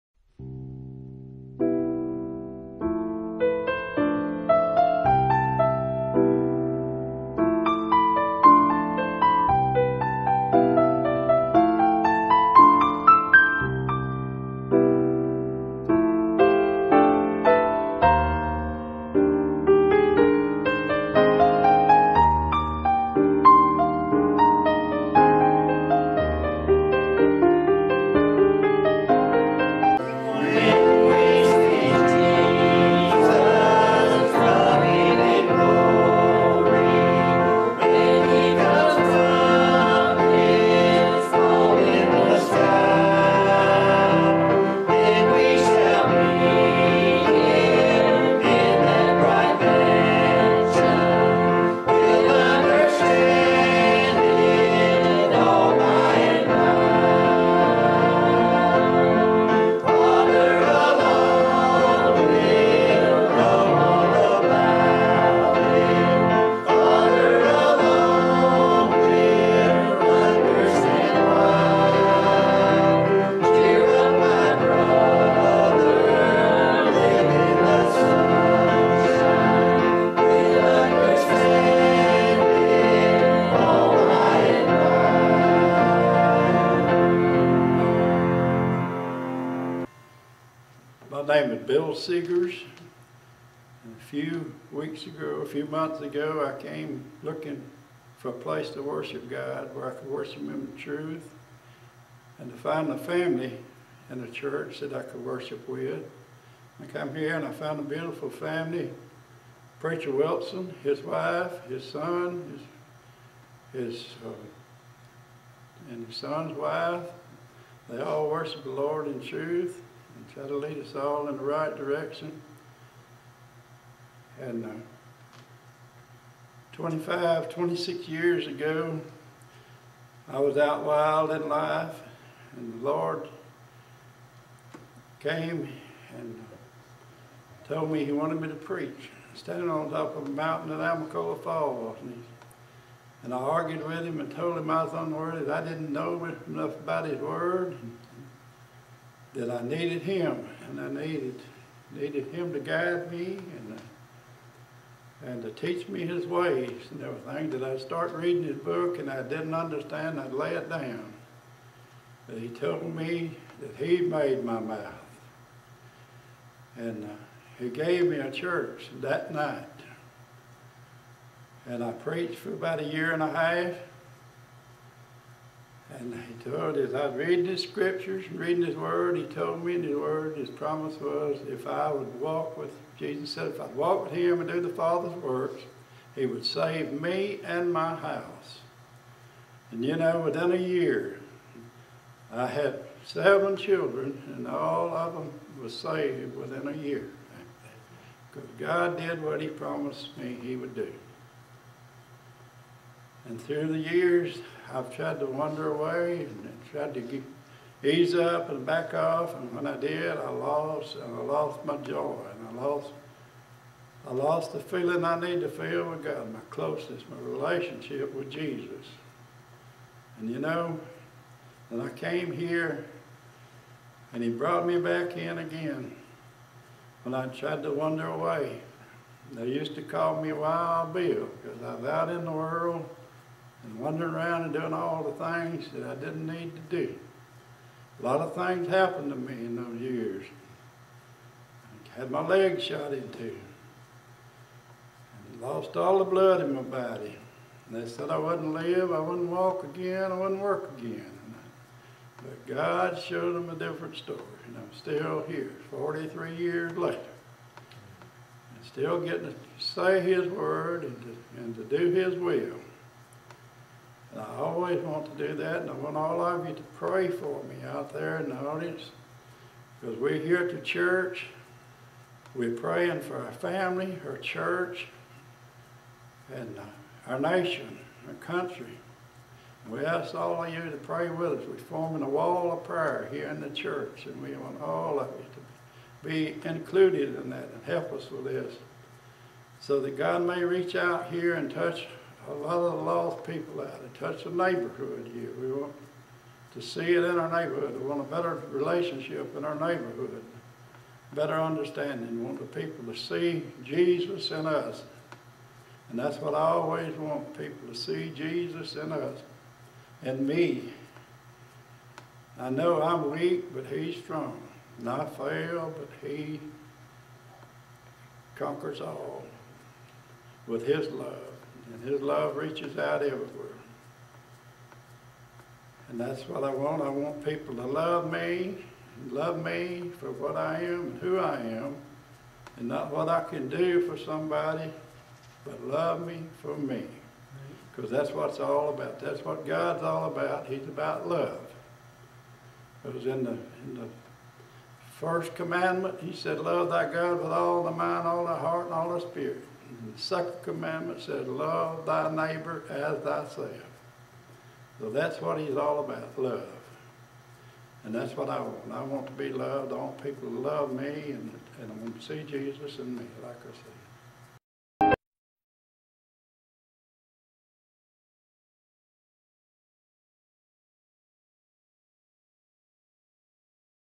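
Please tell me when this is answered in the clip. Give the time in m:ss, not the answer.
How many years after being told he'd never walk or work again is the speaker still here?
4:15.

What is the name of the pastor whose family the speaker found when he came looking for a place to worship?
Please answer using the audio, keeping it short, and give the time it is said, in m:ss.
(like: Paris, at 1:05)
Preacher Wilson, at 1:49.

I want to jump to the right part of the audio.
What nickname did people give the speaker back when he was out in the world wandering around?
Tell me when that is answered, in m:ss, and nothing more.
3:50.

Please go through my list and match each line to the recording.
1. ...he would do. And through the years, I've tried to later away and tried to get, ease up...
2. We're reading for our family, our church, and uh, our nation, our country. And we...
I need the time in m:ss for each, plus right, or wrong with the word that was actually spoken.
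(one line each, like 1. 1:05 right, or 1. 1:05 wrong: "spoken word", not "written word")
1. 3:20 wrong: "wander", not "later"
2. 4:32 wrong: "praying", not "reading".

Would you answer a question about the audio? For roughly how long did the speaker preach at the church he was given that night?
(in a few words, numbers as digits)
a year and a half.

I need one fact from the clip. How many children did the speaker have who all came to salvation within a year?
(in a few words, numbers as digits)
7.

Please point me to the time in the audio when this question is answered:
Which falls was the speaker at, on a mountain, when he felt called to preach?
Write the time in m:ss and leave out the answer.
2:20.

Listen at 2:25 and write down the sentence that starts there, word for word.
I didn't know enough about his word.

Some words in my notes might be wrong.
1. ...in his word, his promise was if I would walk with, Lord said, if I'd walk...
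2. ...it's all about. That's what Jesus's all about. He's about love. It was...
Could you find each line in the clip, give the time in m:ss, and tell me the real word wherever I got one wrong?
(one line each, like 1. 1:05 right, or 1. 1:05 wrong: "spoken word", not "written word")
1. 2:59 wrong: "Jesus", not "Lord"
2. 5:38 wrong: "God", not "Jesus".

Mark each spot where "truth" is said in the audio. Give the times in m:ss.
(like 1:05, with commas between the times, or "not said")
1:40, 1:59.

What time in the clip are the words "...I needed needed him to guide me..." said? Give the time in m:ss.
2:30.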